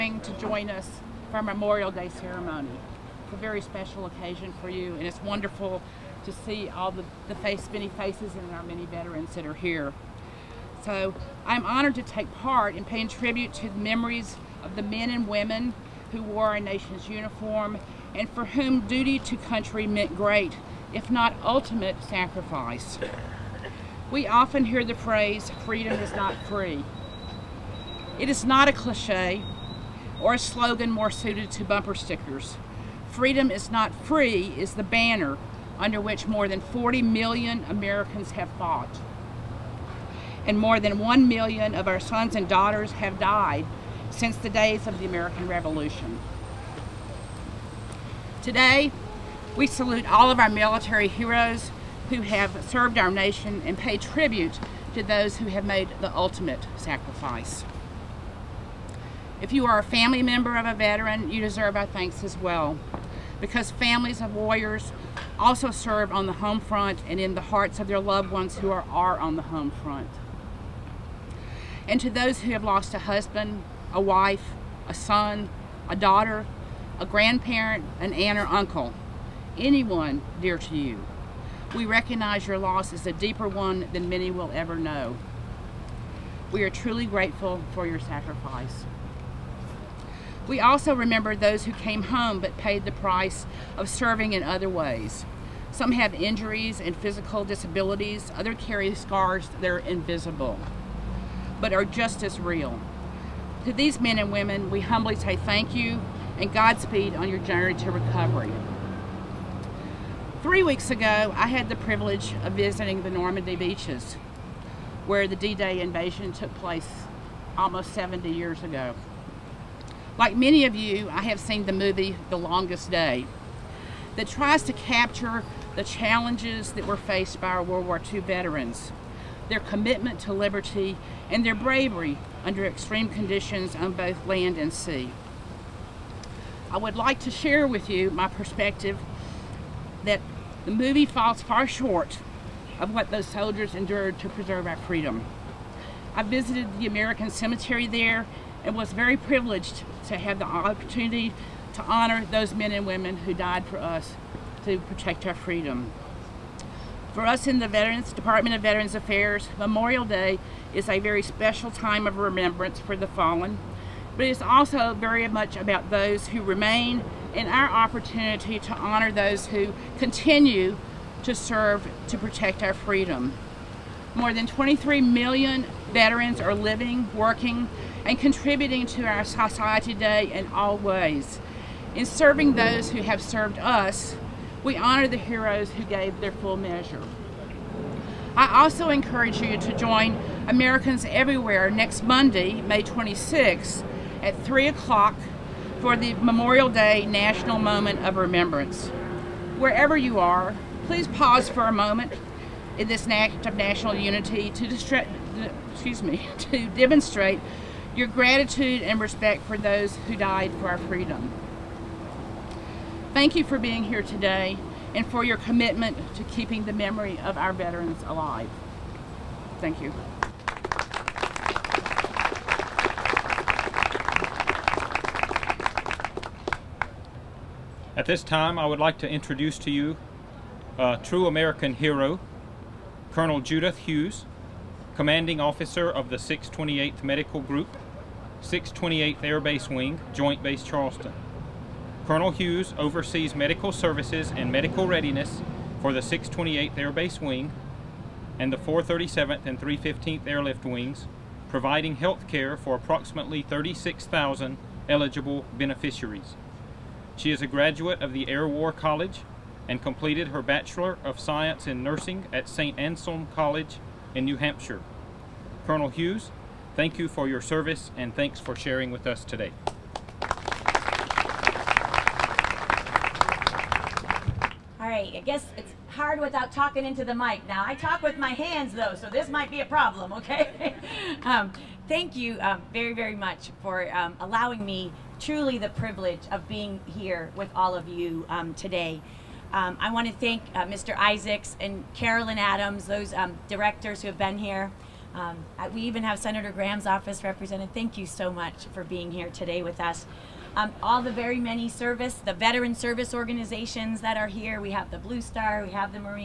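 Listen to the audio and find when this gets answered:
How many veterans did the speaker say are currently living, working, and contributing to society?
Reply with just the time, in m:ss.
2:54.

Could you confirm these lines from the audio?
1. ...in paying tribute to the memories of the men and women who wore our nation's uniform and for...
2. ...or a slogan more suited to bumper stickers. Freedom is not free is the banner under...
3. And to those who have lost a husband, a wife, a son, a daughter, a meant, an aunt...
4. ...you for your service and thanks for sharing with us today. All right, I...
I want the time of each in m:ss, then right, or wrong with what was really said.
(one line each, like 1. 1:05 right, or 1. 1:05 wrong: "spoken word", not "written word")
1. 0:12 right
2. 0:30 right
3. 1:11 wrong: "grandparent", not "meant"
4. 4:26 right.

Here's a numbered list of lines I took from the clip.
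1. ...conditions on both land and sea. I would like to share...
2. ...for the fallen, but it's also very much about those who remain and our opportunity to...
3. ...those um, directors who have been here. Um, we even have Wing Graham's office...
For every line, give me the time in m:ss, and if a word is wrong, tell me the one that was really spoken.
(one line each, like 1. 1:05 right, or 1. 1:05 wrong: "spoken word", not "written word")
1. 2:13 right
2. 2:42 right
3. 4:52 wrong: "Senator", not "Wing".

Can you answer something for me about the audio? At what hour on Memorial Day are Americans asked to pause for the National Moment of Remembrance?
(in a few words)
3 o'clock.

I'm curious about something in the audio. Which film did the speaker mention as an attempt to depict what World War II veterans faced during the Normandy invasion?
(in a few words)
The Longest Day.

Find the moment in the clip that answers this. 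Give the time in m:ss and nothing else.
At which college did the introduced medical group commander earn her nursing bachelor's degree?
4:22.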